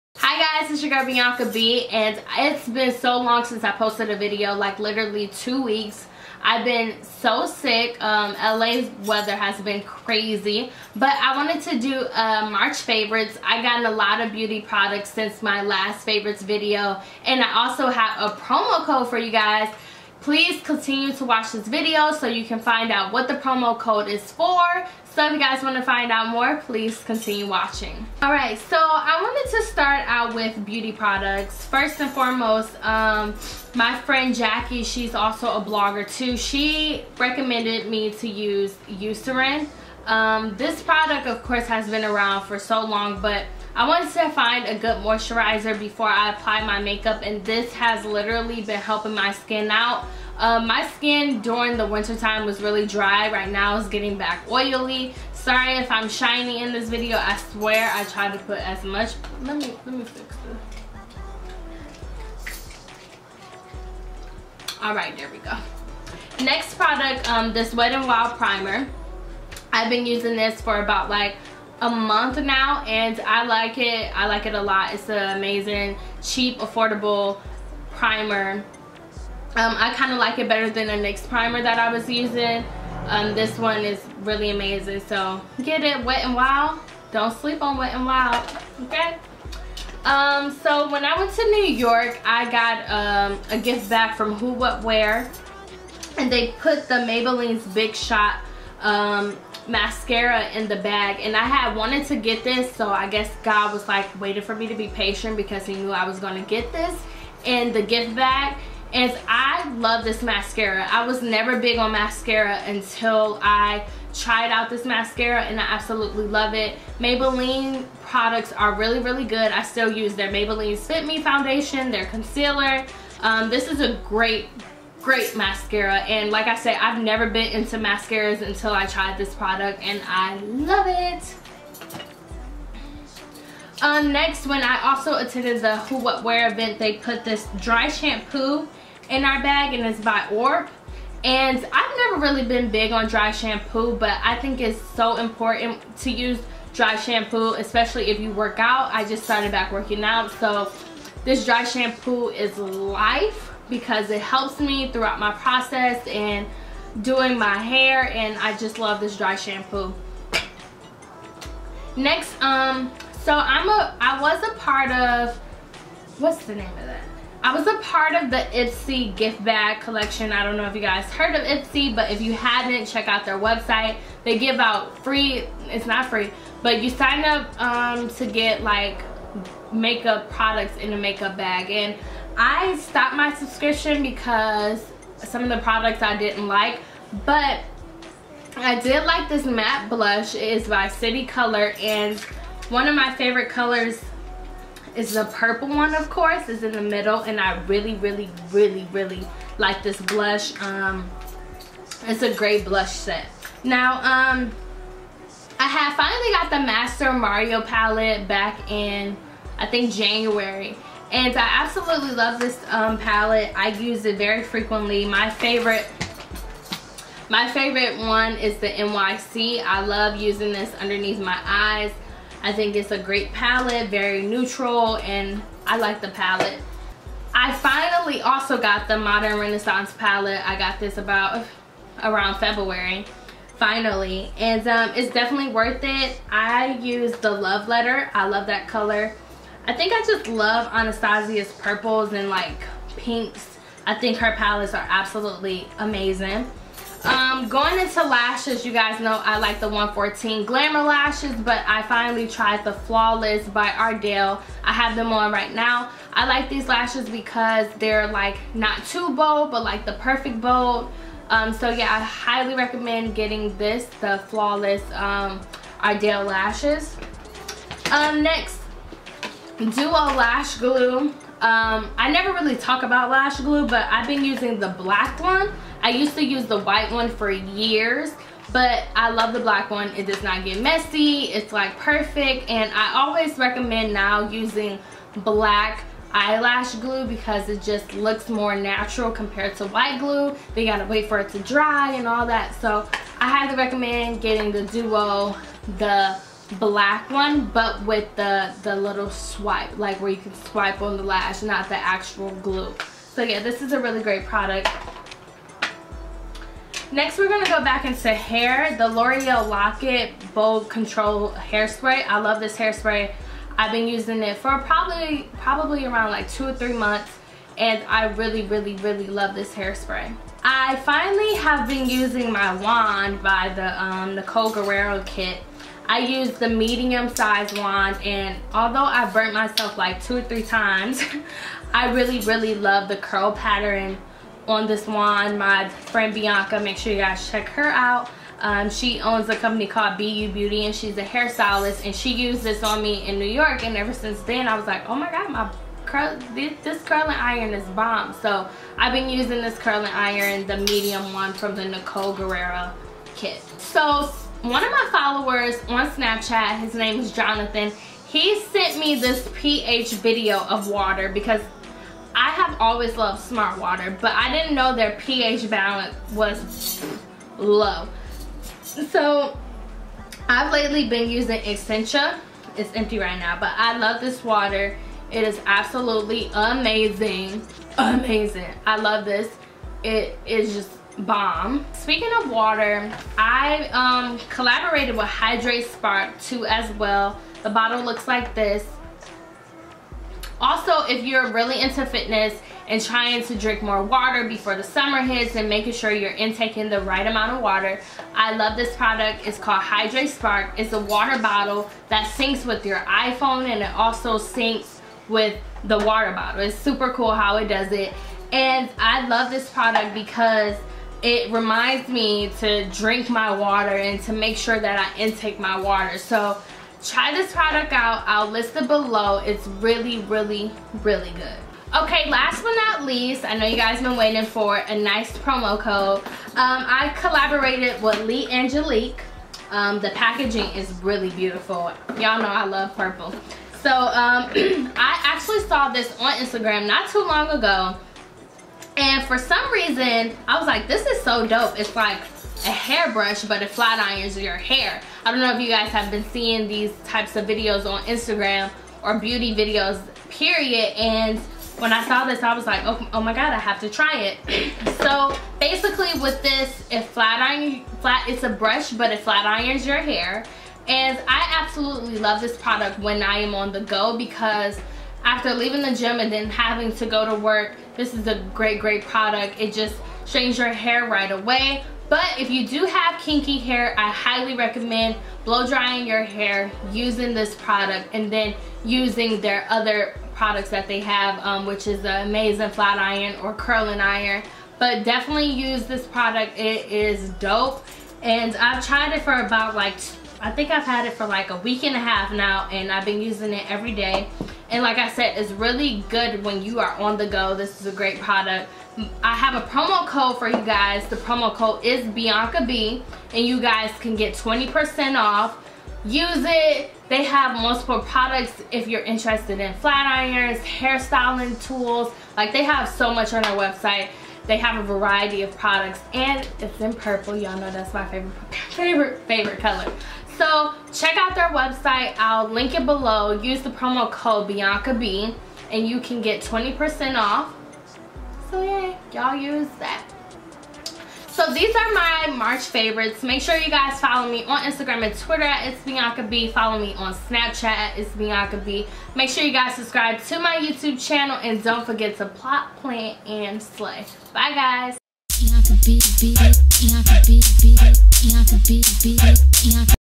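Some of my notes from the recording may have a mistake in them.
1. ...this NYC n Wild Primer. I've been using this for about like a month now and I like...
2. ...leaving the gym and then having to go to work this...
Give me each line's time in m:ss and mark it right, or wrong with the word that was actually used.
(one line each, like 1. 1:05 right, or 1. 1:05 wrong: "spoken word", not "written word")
1. 1:07 wrong: "Wet", not "NYC"
2. 7:45 right.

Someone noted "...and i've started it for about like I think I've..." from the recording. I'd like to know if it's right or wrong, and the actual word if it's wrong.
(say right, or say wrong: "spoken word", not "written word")
wrong: "tried", not "started".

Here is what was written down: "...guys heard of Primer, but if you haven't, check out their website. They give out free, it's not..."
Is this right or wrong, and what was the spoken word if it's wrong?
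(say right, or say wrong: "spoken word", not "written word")
wrong: "Ipsy", not "Primer".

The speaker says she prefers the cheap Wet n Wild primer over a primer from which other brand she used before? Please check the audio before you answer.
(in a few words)
NYX.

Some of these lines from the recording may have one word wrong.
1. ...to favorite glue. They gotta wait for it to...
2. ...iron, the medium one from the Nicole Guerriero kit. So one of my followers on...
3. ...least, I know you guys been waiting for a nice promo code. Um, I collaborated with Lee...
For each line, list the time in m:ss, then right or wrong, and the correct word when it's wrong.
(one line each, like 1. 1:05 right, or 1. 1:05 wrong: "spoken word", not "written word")
1. 4:49 wrong: "white", not "favorite"
2. 5:49 right
3. 7:02 right.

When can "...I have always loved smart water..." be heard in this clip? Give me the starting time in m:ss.
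6:02.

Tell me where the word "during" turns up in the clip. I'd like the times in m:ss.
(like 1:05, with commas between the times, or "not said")
0:51.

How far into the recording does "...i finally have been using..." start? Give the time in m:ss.
5:20.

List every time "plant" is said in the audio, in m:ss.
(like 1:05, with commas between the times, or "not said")
9:02.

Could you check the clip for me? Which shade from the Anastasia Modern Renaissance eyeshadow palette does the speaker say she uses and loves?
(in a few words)
Love Letter.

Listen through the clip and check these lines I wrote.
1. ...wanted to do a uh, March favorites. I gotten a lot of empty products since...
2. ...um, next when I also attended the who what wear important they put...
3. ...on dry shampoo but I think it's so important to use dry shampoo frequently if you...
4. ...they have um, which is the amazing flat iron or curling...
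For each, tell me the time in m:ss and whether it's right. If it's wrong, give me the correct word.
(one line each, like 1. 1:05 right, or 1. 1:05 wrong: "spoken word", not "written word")
1. 0:11 wrong: "beauty", not "empty"
2. 2:13 wrong: "event", not "important"
3. 2:22 wrong: "especially", not "frequently"
4. 8:00 right.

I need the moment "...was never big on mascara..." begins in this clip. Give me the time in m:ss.
1:51.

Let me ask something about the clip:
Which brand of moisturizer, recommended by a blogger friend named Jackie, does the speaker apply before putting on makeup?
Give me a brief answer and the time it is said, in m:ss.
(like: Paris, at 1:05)
Eucerin, at 0:38.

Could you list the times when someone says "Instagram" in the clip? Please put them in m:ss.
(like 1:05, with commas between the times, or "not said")
7:16, 7:27, 8:54.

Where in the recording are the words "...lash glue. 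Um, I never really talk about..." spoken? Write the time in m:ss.
4:30.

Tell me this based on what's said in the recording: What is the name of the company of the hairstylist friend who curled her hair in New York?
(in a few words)
BU Beauty.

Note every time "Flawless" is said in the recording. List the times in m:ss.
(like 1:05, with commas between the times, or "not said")
4:12, 4:24.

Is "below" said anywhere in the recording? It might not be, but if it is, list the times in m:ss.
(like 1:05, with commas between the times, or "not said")
6:58, 8:42.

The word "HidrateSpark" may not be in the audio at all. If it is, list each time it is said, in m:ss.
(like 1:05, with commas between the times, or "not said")
6:25, 6:39.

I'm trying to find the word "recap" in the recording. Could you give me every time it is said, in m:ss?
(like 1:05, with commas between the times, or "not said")
not said.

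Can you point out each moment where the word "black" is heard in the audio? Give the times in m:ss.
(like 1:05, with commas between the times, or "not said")
4:34, 4:39, 4:45, 4:56.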